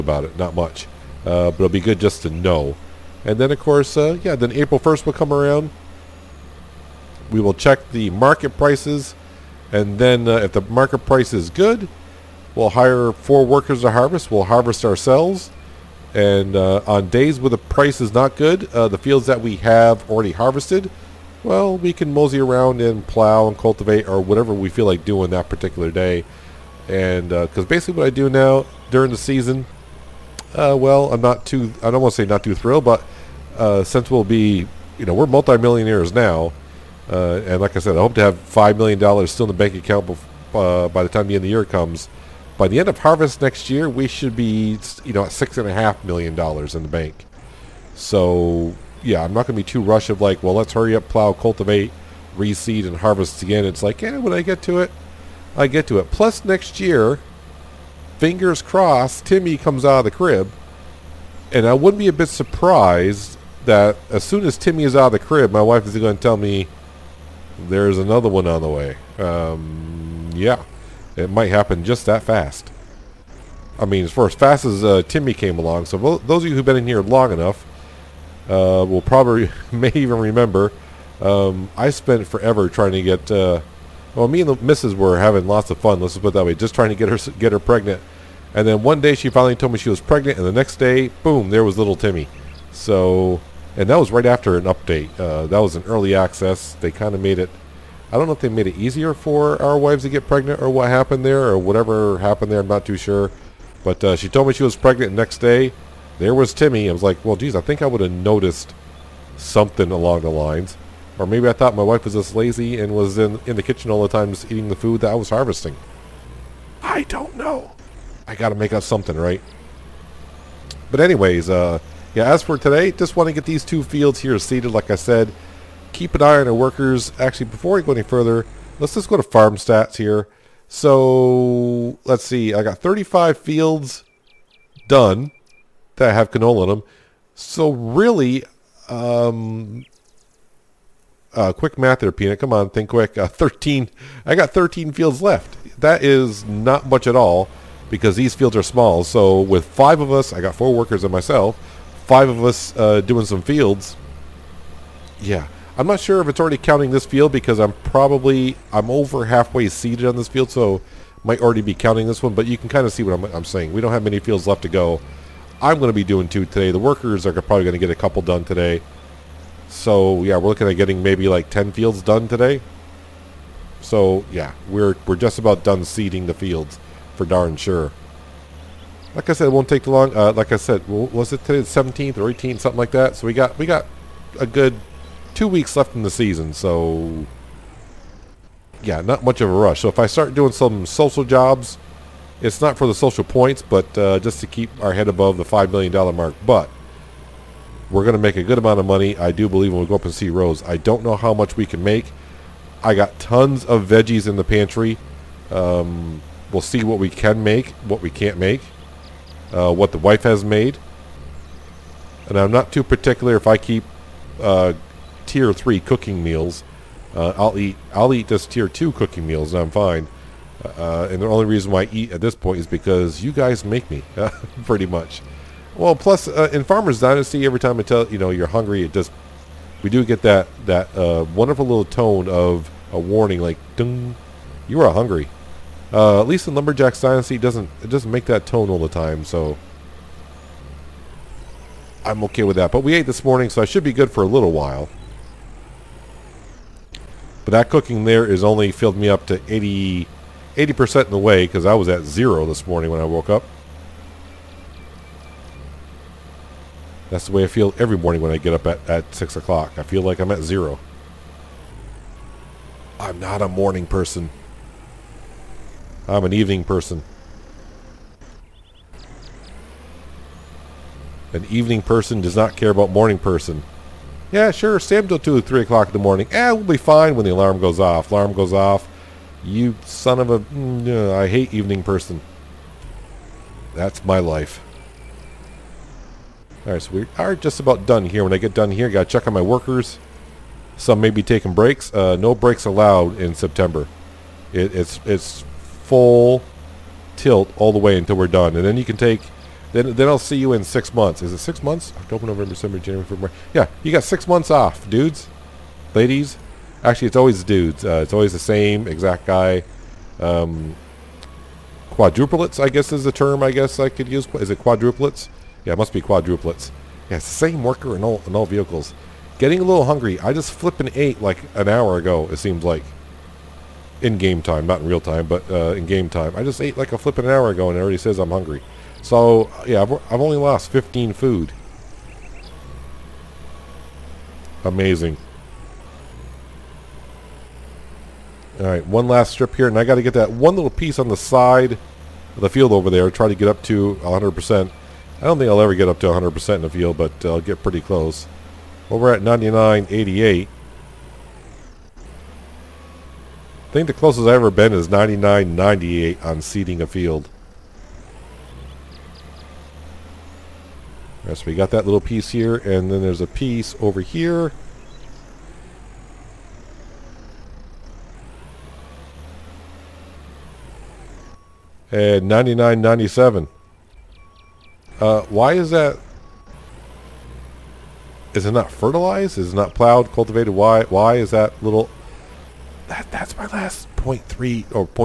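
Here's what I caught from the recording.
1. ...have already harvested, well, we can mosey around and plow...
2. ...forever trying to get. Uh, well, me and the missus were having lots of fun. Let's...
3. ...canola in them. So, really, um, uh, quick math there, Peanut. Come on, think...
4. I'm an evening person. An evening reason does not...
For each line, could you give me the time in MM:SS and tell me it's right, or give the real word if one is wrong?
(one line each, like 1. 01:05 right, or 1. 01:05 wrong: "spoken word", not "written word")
1. 00:19 right
2. 01:22 right
3. 02:16 right
4. 04:26 wrong: "person", not "reason".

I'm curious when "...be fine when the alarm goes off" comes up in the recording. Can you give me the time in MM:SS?
04:36.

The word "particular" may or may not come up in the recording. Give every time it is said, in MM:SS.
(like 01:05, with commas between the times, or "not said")
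00:25, 03:32.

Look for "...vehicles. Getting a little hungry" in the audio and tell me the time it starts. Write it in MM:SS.
05:18.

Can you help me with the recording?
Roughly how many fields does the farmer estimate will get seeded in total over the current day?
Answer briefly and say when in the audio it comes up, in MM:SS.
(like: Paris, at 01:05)
10, at 02:51.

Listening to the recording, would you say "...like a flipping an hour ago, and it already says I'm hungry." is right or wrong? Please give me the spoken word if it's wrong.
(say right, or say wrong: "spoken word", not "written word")
right.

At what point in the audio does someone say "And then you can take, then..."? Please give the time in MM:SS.
04:58.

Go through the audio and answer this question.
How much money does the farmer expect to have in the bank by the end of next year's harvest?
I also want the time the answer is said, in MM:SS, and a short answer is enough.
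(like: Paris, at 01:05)
$6.5 million, at 00:45.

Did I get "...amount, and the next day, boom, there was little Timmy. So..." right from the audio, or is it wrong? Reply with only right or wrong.
wrong.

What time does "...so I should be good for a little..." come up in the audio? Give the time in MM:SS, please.
04:03.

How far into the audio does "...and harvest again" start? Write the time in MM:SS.
00:52.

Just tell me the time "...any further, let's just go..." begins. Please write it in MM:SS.
02:07.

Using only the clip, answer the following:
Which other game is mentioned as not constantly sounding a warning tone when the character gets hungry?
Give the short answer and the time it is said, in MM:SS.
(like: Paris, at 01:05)
Lumberjack's Dynasty, at 03:56.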